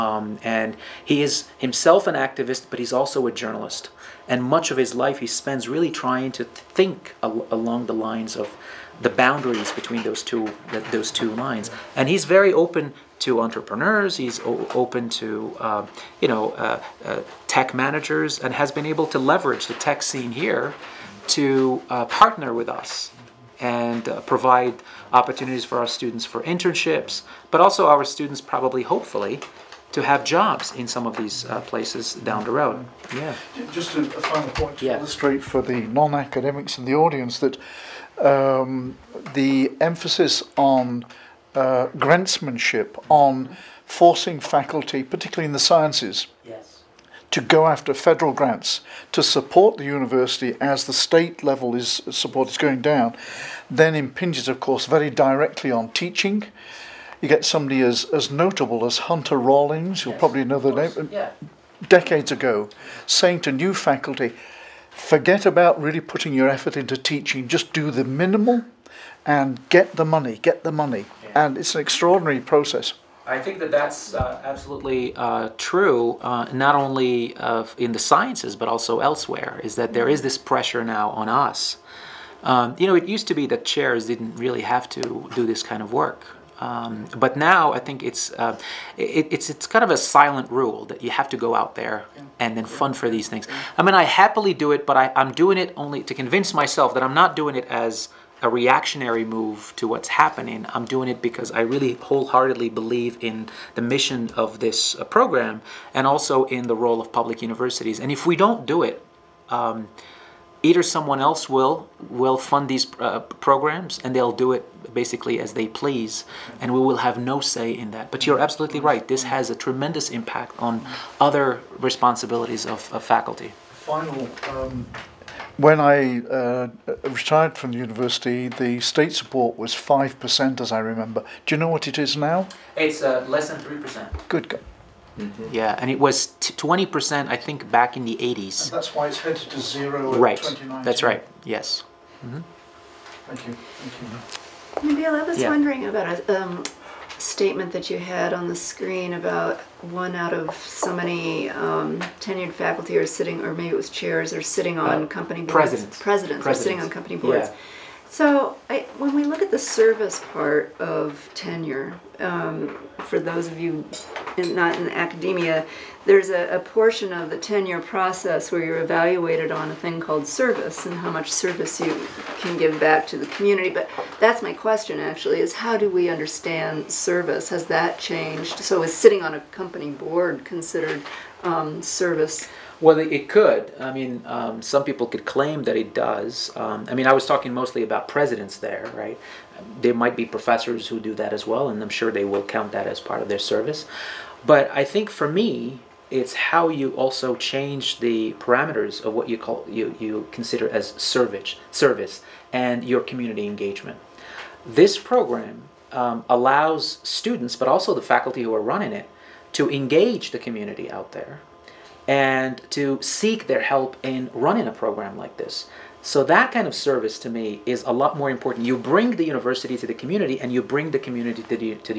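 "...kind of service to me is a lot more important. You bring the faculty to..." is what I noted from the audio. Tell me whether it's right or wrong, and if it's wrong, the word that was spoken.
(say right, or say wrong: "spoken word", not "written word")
wrong: "university", not "faculty".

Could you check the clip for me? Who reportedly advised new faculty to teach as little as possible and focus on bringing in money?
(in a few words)
Hunter Rawlings.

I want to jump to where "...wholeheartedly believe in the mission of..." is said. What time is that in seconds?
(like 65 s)
101 s.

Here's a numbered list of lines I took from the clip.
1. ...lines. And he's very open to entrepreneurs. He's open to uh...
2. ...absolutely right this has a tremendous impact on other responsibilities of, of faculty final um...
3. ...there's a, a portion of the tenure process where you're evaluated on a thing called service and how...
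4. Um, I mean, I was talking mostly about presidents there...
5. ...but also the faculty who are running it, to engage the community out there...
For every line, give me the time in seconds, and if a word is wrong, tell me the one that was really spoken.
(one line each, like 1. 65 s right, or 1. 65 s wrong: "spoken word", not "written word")
1. 11 s right
2. 118 s right
3. 166 s right
4. 186 s right
5. 207 s right.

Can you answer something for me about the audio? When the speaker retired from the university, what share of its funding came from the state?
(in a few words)
5%.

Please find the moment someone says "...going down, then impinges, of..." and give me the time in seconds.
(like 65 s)
52 s.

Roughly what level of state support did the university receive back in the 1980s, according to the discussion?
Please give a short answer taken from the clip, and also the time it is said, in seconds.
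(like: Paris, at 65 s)
20%, at 136 s.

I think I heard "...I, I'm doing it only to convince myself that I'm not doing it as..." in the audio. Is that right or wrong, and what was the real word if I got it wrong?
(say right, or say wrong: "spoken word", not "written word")
right.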